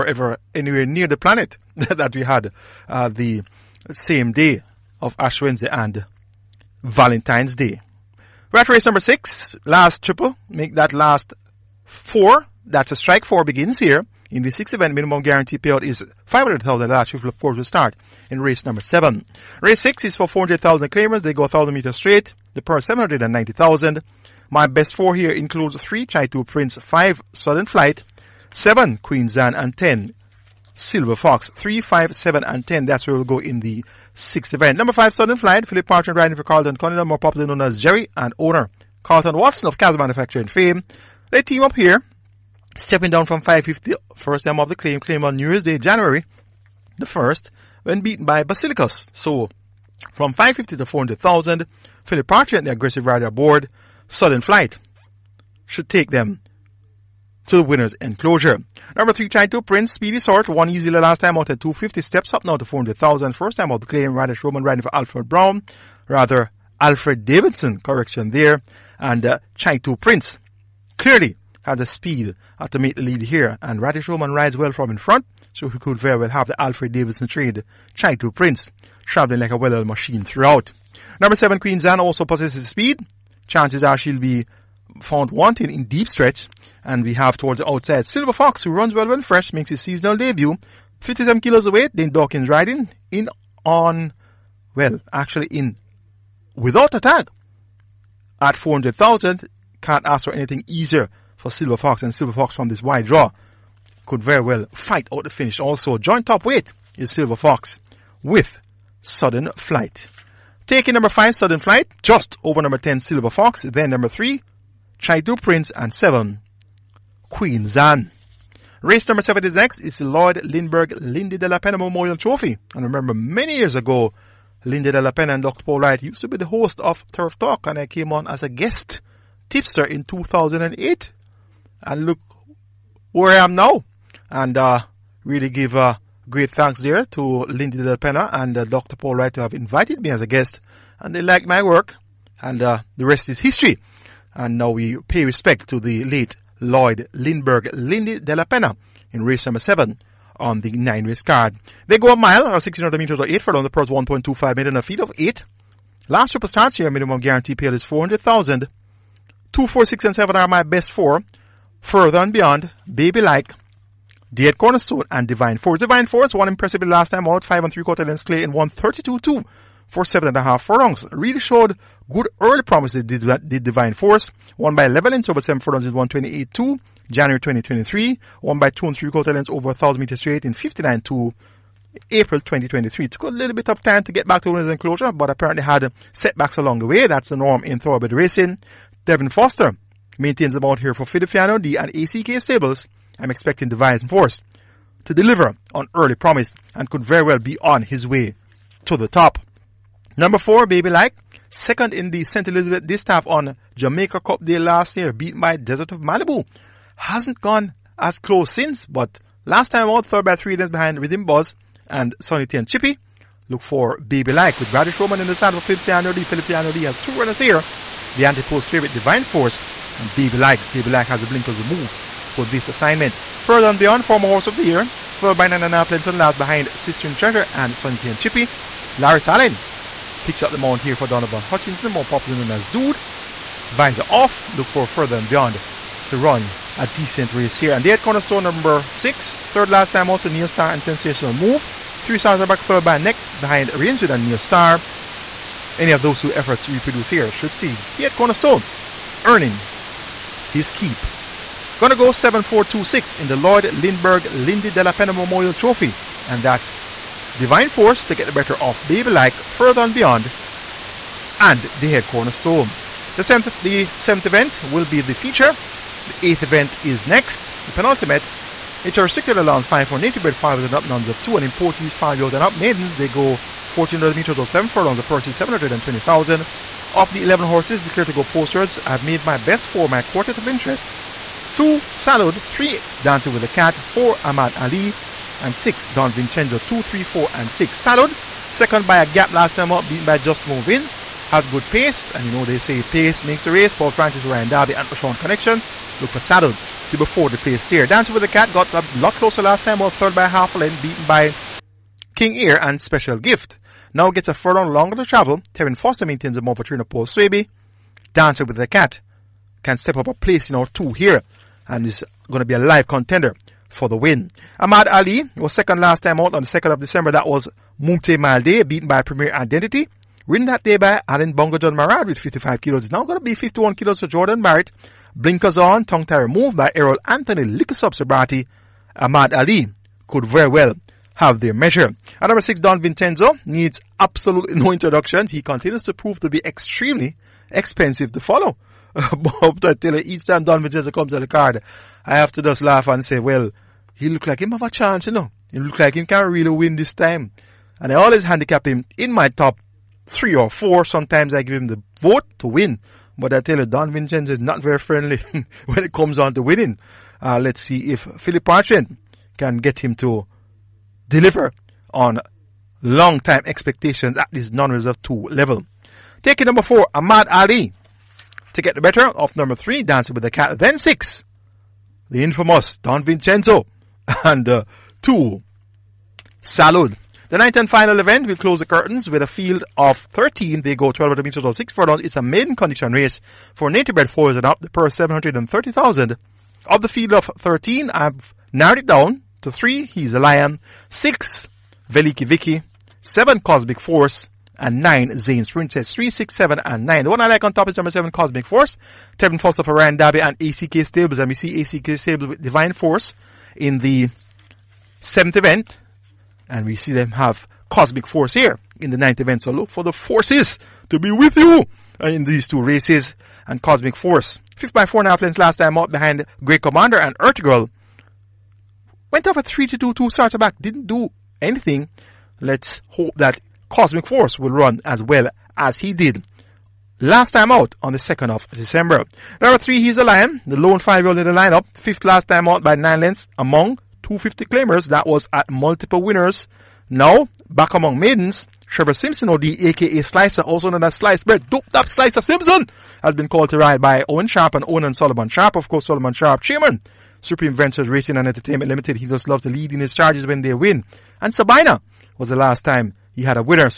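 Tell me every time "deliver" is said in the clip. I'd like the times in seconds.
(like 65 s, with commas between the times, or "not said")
195 s, 361 s.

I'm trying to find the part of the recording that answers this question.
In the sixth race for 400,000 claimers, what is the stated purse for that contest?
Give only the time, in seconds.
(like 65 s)
22 s.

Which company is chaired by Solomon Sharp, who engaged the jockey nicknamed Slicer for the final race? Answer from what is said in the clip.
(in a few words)
Supreme Ventures Racing and Entertainment Limited.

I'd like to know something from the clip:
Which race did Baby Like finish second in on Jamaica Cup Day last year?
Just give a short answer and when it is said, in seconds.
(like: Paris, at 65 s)
St. Elizabeth Distaff, at 202 s.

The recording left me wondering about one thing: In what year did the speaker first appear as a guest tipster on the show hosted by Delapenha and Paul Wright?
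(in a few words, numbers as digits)
2008.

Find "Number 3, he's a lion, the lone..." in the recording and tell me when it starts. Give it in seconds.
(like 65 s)
429 s.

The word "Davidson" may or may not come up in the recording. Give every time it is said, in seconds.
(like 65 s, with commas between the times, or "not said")
67 s, 76 s.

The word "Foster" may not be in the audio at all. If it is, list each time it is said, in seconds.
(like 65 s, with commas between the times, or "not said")
189 s, 305 s, 399 s.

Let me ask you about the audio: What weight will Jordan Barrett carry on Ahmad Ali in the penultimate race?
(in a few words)
51 kilos.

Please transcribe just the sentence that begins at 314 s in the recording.
Ahmad Ali was second last time out on the 2nd of December.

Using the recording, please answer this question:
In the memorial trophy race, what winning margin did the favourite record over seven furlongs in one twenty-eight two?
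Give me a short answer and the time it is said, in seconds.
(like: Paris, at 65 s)
11 lengths, at 174 s.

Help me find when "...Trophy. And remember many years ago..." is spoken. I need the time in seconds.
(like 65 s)
122 s.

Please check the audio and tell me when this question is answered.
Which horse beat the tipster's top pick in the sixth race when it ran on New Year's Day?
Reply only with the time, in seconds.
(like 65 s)
48 s.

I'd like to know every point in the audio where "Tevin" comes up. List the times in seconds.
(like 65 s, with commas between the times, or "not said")
189 s, 399 s.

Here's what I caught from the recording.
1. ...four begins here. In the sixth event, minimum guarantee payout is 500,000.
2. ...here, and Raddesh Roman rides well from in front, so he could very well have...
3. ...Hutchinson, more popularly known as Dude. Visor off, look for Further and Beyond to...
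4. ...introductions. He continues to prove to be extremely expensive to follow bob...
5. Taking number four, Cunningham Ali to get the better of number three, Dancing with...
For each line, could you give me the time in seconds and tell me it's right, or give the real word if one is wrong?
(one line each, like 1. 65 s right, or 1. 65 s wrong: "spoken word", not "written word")
1. 13 s right
2. 73 s right
3. 231 s right
4. 334 s right
5. 366 s wrong: "Ahmad", not "Cunningham".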